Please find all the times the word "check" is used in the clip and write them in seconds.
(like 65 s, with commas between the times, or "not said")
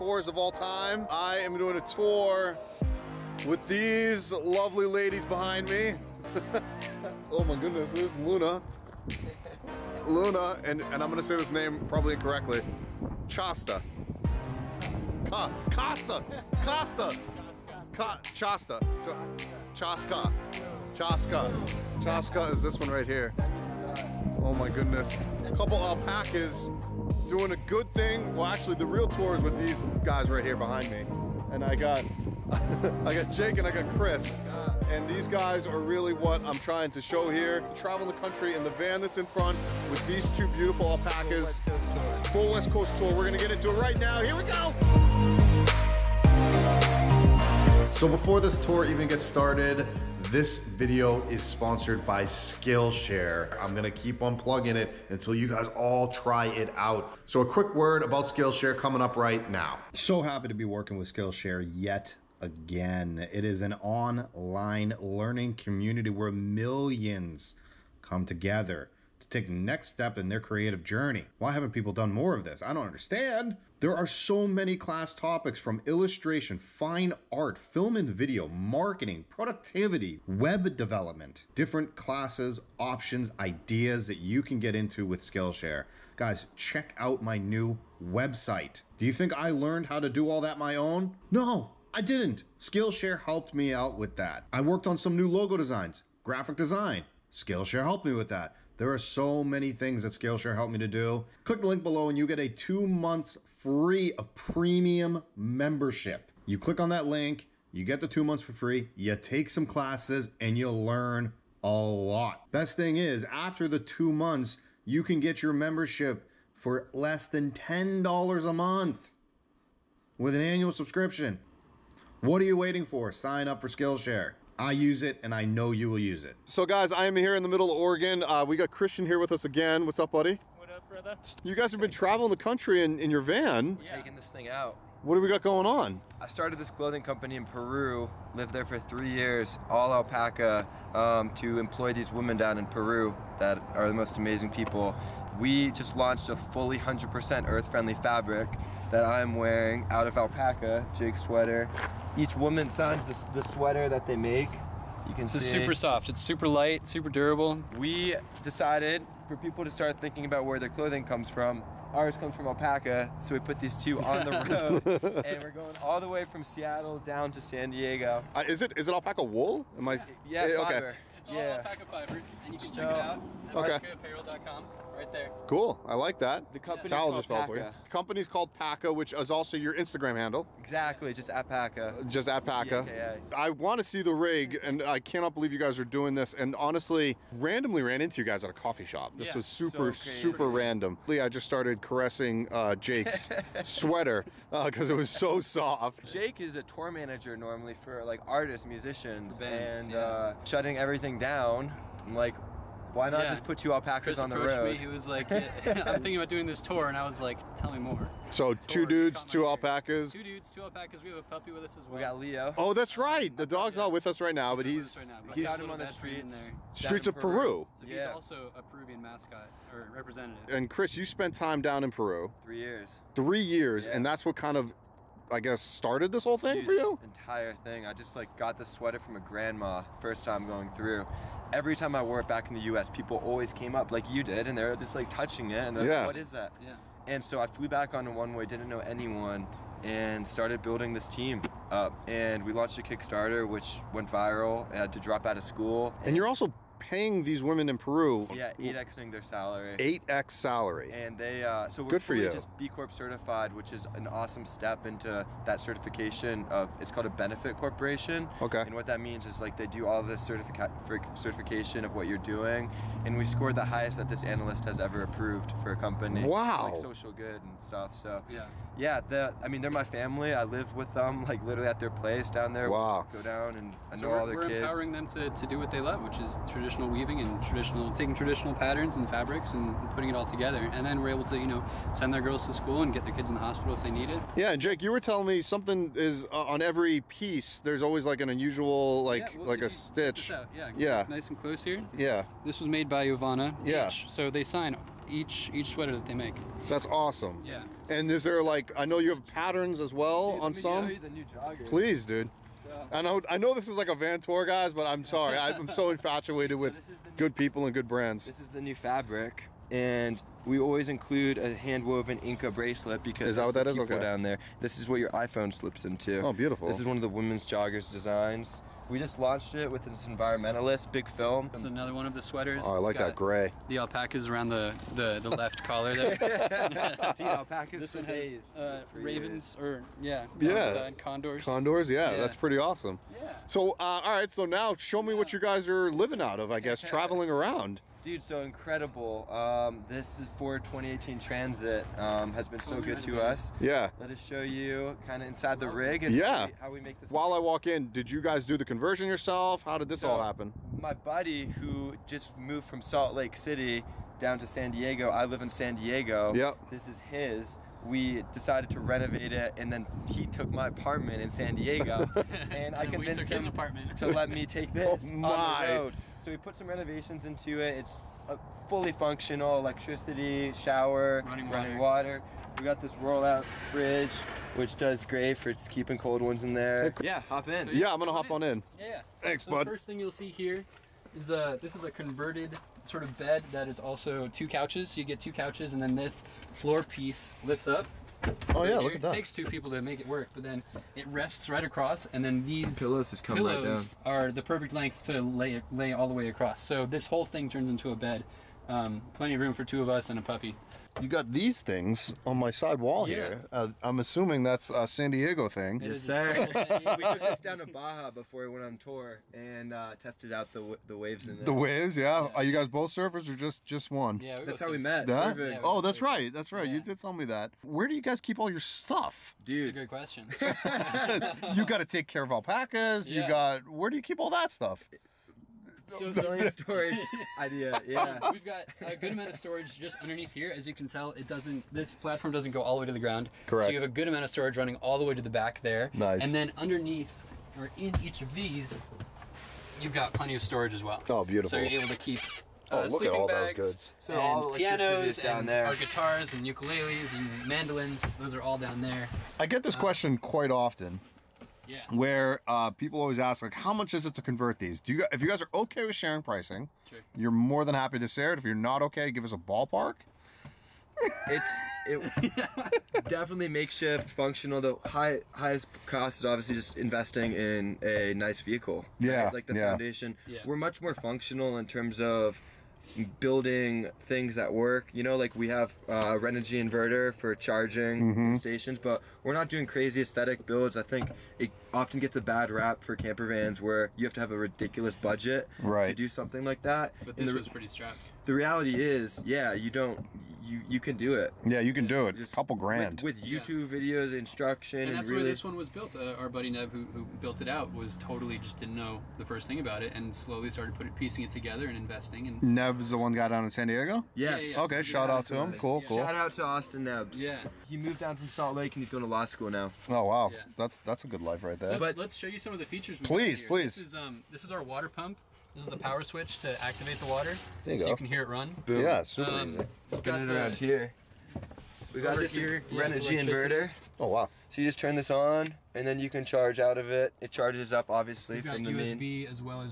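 86 s, 172 s.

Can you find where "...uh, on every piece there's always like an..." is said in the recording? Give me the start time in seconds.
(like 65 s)
286 s.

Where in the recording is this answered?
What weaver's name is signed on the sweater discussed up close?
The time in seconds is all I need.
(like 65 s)
293 s.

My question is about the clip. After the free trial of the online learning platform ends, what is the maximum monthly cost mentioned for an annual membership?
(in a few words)
$10.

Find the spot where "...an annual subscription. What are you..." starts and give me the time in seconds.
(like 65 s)
120 s.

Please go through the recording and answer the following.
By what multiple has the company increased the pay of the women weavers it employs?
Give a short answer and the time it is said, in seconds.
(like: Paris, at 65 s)
8x, at 248 s.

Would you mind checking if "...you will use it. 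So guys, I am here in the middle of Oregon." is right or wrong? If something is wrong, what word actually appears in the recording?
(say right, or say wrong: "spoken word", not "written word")
right.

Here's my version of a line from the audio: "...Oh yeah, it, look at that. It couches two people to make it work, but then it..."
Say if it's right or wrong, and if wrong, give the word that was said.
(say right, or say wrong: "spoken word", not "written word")
wrong: "takes", not "couches".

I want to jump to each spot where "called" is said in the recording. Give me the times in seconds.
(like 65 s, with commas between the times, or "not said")
178 s, 256 s.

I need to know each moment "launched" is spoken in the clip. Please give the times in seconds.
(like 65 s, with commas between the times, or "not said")
145 s, 242 s, 319 s.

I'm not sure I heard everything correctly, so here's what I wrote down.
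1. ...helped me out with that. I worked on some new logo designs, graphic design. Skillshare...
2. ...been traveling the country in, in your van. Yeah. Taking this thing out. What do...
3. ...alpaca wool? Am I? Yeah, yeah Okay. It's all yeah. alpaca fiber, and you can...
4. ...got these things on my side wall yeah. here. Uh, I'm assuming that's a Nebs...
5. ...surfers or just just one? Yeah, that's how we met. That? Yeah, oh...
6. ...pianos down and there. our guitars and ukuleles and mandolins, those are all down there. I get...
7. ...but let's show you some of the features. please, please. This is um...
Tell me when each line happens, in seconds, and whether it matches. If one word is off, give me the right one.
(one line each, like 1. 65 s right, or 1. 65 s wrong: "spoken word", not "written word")
1. 93 s right
2. 131 s right
3. 168 s right
4. 401 s wrong: "San", not "Nebs"
5. 412 s right
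6. 444 s right
7. 511 s right.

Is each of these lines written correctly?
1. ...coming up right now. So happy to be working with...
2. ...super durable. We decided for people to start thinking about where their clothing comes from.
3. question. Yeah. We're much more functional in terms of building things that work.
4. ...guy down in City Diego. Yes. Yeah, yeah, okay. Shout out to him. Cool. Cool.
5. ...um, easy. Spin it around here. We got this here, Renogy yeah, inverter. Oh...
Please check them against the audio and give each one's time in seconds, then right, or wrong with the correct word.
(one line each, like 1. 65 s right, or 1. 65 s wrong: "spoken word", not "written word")
1. 58 s right
2. 156 s right
3. 469 s wrong: "foundation", not "question"
4. 503 s wrong: "San", not "City"
5. 519 s right.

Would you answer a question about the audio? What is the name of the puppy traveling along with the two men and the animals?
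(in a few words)
Leo.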